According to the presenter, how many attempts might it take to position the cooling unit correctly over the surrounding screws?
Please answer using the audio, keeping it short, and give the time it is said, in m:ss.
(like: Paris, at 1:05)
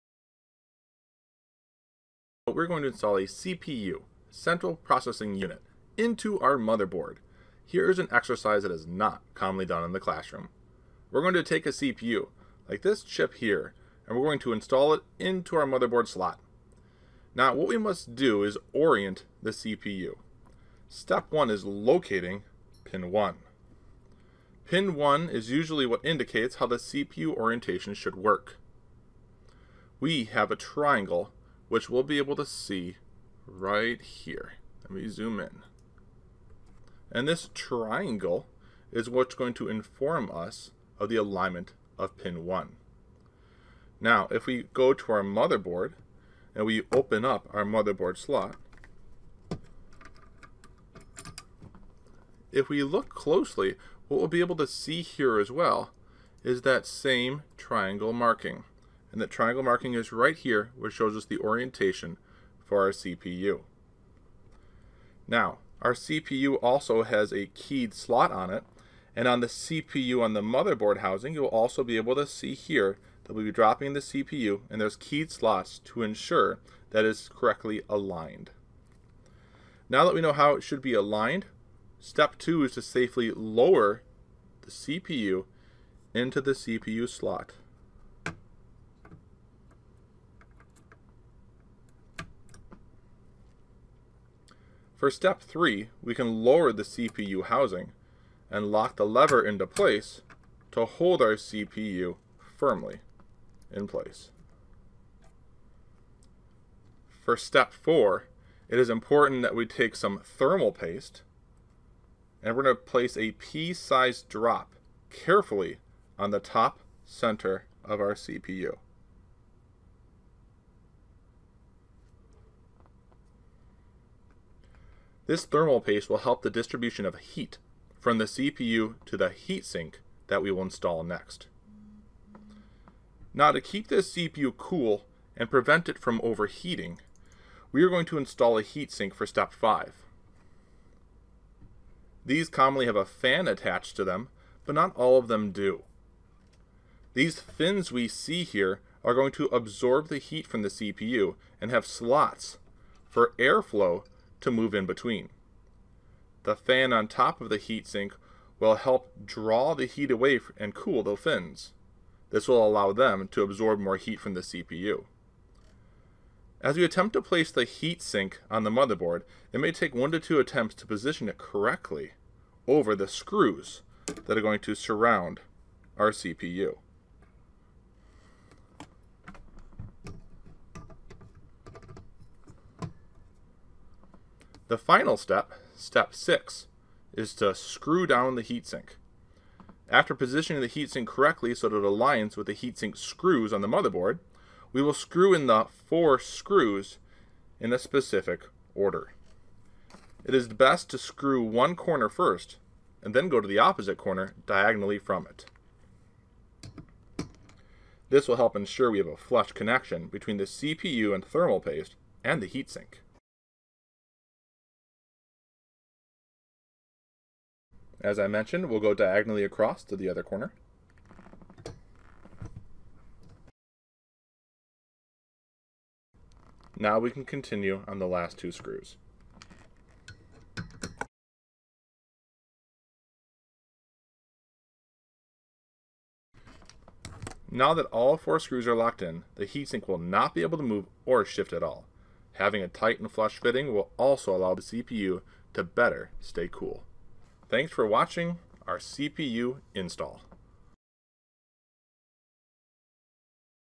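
1 to 2, at 2:49.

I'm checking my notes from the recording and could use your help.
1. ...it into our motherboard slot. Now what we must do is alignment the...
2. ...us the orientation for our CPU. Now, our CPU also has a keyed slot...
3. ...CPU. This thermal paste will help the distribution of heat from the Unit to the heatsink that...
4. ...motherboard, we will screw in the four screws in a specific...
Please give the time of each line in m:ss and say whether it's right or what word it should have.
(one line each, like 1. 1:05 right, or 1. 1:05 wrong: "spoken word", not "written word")
1. 0:14 wrong: "orient", not "alignment"
2. 1:01 right
3. 1:58 wrong: "CPU", not "Unit"
4. 3:13 right.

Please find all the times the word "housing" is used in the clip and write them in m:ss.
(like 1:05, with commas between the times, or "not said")
1:10, 1:37.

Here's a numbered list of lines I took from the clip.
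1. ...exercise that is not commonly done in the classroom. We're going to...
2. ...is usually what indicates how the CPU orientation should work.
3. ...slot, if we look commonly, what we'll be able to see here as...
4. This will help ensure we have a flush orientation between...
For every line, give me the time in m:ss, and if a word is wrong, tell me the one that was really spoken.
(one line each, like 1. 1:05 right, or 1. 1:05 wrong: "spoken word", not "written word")
1. 0:08 right
2. 0:25 right
3. 0:48 wrong: "closely", not "commonly"
4. 3:28 wrong: "connection", not "orientation".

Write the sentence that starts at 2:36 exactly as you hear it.
The fan on top of the heatsink will help draw the heat away and cool the fins.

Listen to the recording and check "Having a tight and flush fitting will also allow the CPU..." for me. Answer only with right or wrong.
right.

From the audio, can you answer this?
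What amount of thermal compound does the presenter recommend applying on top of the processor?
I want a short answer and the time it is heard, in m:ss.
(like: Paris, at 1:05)
Pea-sized drop, at 1:53.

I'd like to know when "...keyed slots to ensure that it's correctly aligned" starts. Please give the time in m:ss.
1:14.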